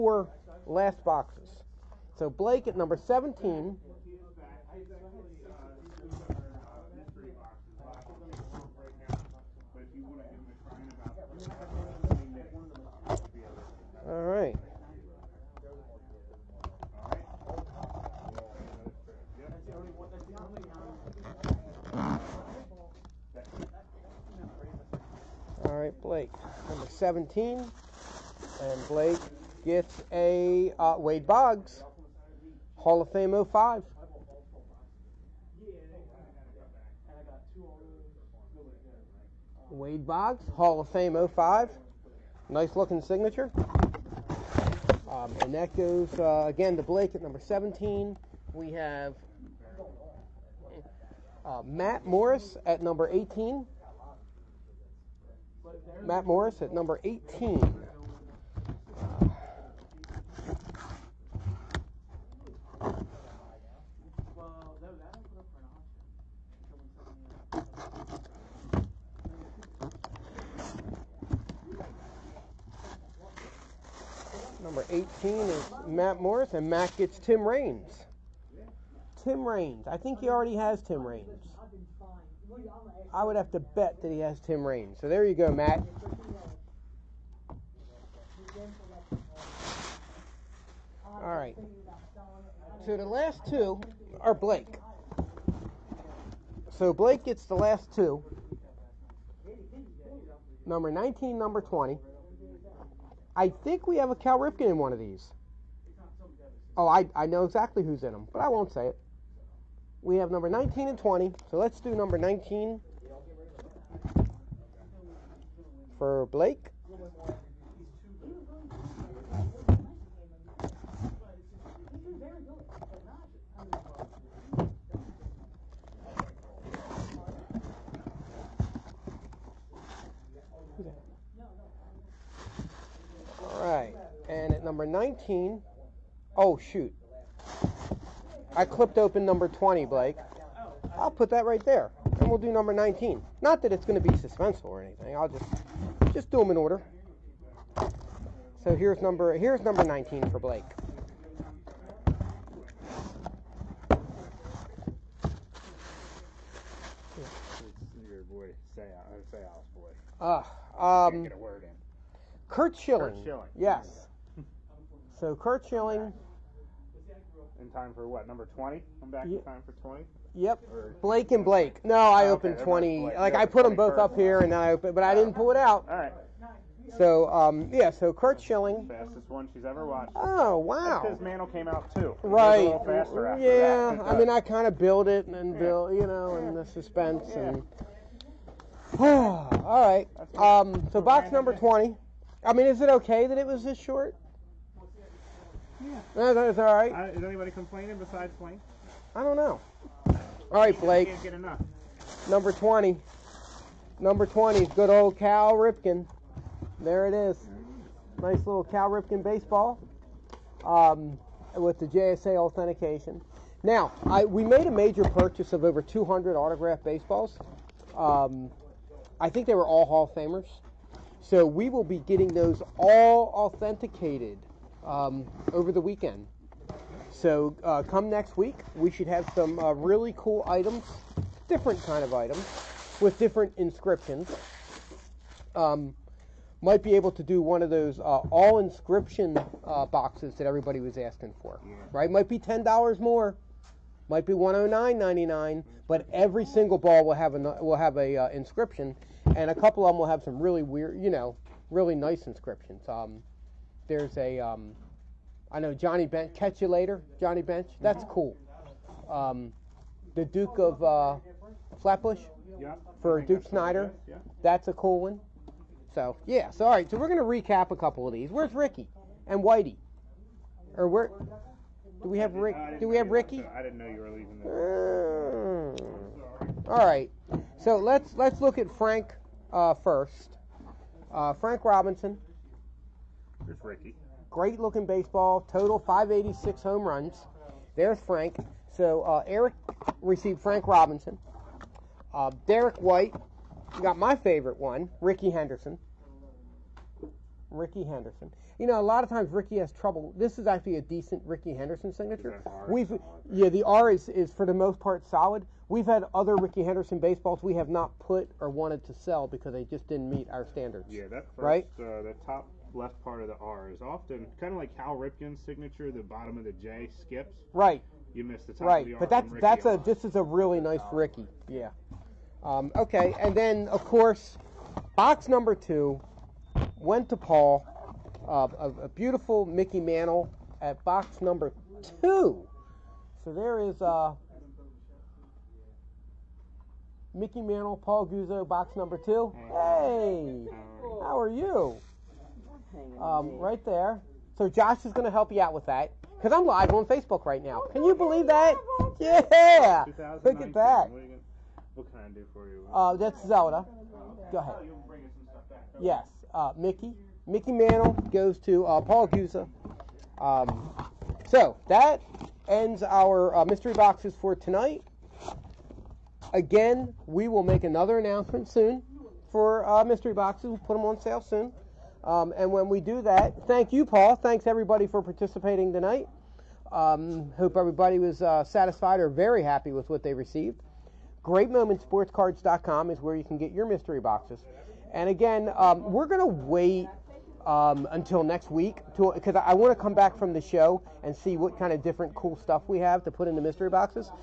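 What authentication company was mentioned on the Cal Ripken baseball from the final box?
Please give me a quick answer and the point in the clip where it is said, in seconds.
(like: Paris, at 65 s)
JSA, at 211 s.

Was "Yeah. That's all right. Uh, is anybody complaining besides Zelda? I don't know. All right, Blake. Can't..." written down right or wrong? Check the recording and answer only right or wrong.
wrong.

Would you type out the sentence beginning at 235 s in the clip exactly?
Um, might be able to do one of those uh, all inscription uh, boxes that everybody was asking for.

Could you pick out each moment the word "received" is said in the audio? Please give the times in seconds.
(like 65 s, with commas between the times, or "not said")
290 s, 380 s.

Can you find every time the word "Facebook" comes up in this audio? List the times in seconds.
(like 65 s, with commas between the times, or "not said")
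346 s.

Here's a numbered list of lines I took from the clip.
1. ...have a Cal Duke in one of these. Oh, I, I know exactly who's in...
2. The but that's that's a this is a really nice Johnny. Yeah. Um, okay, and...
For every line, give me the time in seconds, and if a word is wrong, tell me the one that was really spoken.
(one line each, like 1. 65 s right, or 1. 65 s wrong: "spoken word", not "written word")
1. 103 s wrong: "Ripken", not "Duke"
2. 318 s wrong: "Ricky", not "Johnny".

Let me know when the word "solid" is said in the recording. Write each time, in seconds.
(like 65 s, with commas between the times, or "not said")
305 s.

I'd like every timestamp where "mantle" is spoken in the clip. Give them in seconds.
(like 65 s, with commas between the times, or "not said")
181 s, 329 s, 337 s, 357 s.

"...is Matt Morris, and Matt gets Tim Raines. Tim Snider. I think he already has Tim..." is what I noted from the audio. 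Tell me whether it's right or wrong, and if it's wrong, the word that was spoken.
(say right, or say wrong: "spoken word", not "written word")
wrong: "Raines", not "Snider".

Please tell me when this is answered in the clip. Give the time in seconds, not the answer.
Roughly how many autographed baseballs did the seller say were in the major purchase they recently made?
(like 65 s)
215 s.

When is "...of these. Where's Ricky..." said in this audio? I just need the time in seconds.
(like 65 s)
268 s.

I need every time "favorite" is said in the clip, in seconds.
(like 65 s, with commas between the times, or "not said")
294 s.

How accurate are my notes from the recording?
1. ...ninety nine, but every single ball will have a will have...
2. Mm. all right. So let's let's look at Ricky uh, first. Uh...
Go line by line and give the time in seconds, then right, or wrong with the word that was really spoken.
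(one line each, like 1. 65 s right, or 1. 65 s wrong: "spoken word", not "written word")
1. 244 s right
2. 275 s wrong: "Frank", not "Ricky".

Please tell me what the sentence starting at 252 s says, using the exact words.
Um, there's a, um, I know Johnny Bench, catch you later, Johnny Bench.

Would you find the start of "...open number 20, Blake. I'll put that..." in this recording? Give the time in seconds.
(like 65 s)
138 s.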